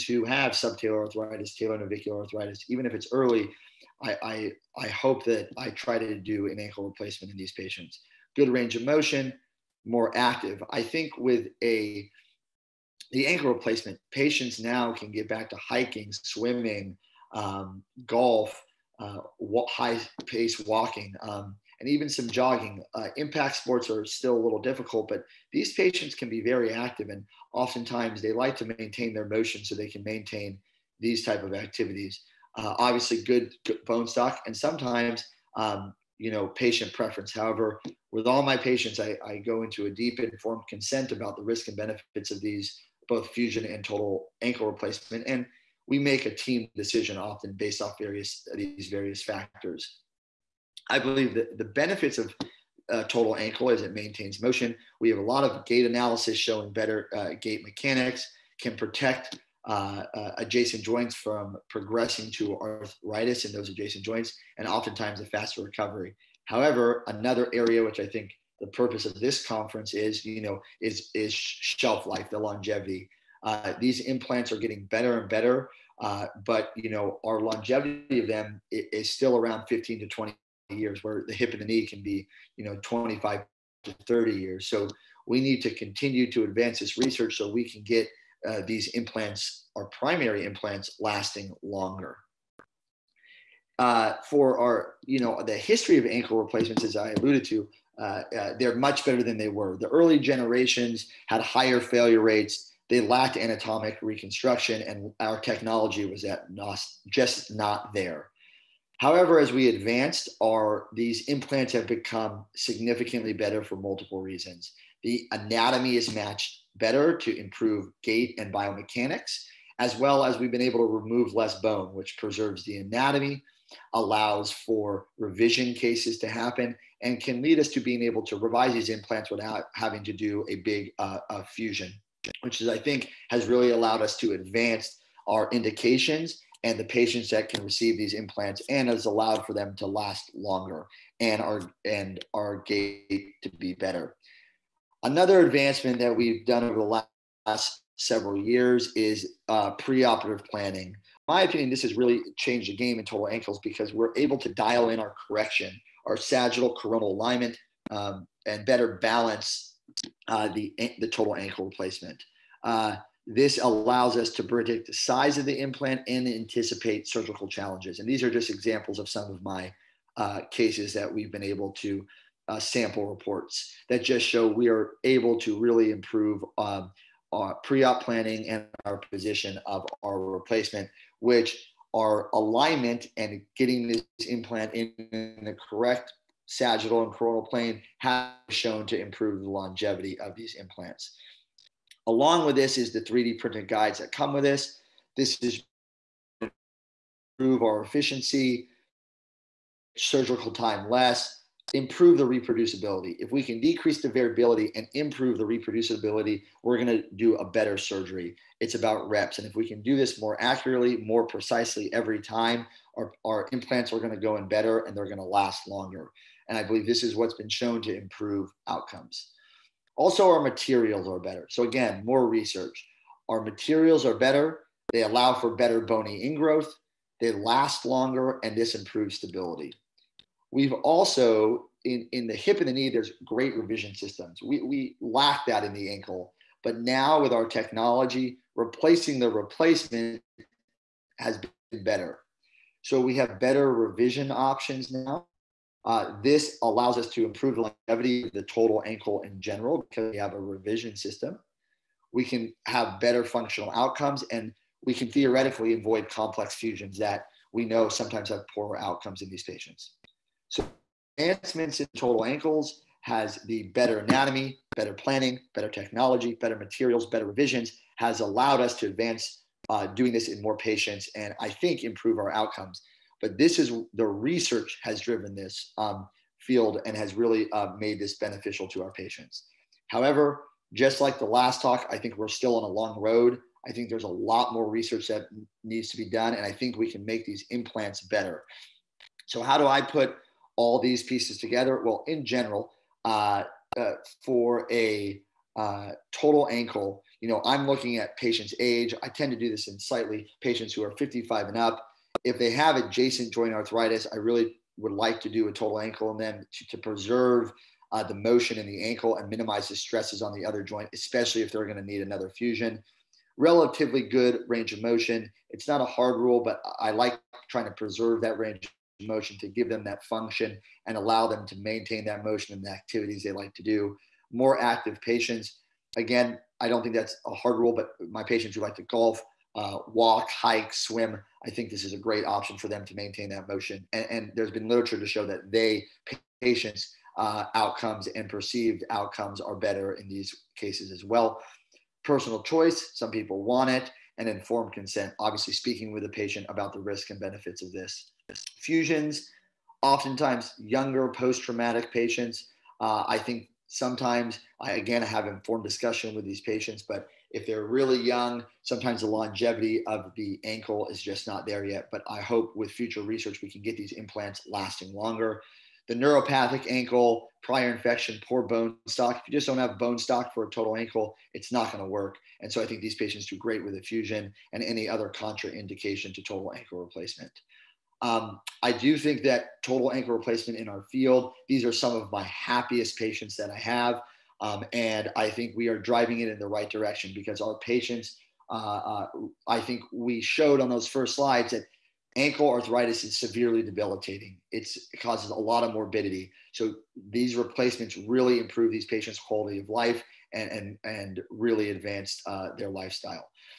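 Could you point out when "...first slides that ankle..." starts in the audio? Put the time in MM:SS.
06:30.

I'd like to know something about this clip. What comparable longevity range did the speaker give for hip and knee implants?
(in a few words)
25 to 30 years.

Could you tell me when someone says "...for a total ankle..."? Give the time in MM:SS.
06:10.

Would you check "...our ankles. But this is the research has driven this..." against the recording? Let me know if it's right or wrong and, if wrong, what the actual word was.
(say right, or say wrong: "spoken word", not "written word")
wrong: "outcomes", not "ankles".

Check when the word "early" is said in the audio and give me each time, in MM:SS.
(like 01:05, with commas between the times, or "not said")
00:03, 01:39.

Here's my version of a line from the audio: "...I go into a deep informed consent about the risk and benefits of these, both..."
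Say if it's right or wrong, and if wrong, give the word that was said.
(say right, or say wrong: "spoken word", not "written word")
right.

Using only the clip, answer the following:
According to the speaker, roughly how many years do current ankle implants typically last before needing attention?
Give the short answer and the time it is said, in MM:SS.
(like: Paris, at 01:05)
15 to 20 years, at 01:19.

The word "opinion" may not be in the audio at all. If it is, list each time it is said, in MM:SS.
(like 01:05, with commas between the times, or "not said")
02:31.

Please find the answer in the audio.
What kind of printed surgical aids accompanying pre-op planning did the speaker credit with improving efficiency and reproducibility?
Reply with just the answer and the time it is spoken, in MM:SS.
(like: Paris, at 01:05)
3D printed guides, at 03:13.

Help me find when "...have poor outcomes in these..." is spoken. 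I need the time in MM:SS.
04:18.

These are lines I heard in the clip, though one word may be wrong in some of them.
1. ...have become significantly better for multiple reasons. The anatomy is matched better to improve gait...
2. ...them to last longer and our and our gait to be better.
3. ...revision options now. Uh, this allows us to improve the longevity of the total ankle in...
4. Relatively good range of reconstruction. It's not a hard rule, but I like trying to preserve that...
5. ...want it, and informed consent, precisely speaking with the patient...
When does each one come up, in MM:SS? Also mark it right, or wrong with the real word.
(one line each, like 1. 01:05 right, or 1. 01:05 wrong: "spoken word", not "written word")
1. 01:51 right
2. 02:19 right
3. 04:03 right
4. 05:13 wrong: "motion", not "reconstruction"
5. 05:43 wrong: "obviously", not "precisely".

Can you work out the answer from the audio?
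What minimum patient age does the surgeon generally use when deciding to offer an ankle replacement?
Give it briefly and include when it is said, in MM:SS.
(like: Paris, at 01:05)
55 and up, at 05:00.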